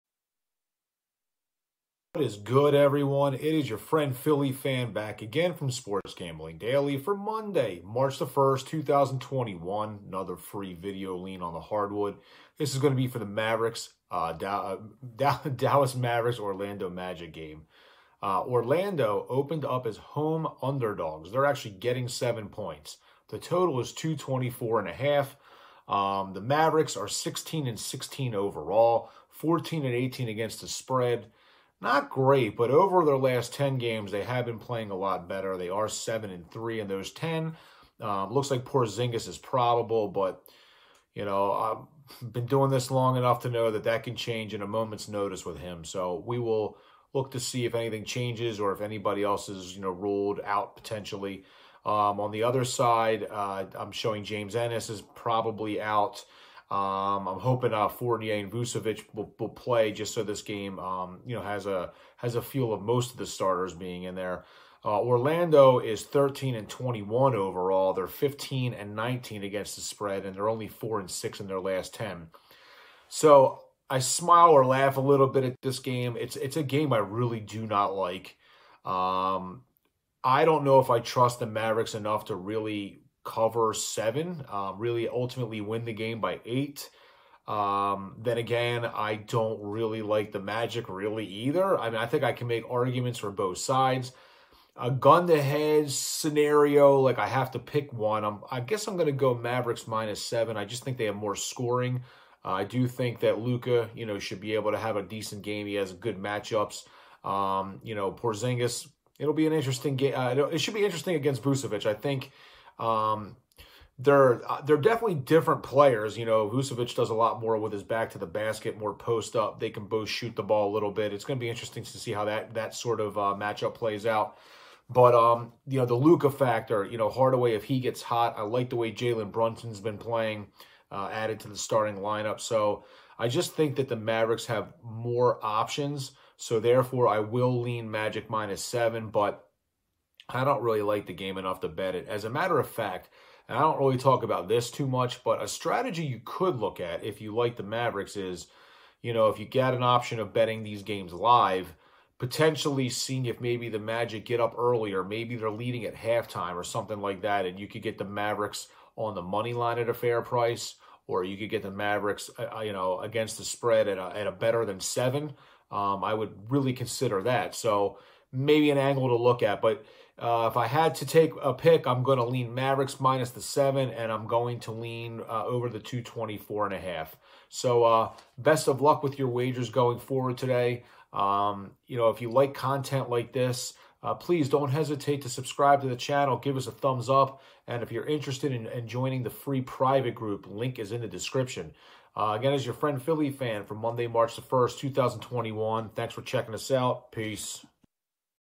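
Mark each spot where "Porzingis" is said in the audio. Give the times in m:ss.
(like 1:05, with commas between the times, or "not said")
0:38, 1:48.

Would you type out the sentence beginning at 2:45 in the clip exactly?
Um, I would really consider that.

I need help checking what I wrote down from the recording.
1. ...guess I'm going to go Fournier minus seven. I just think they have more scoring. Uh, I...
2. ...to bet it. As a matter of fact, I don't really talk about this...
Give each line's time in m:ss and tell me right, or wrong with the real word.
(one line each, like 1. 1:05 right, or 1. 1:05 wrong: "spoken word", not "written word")
1. 1:38 wrong: "Mavericks", not "Fournier"
2. 2:21 right.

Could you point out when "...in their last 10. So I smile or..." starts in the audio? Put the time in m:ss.
1:11.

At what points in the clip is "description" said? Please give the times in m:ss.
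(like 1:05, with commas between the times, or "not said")
3:11.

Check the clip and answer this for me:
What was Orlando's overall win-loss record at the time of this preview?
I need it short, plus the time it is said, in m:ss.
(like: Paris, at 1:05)
13-21, at 1:06.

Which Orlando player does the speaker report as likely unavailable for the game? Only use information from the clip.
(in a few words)
James Ennis.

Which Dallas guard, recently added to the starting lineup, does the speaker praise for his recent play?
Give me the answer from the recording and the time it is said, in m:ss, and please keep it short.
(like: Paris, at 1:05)
Jalen Brunson, at 2:08.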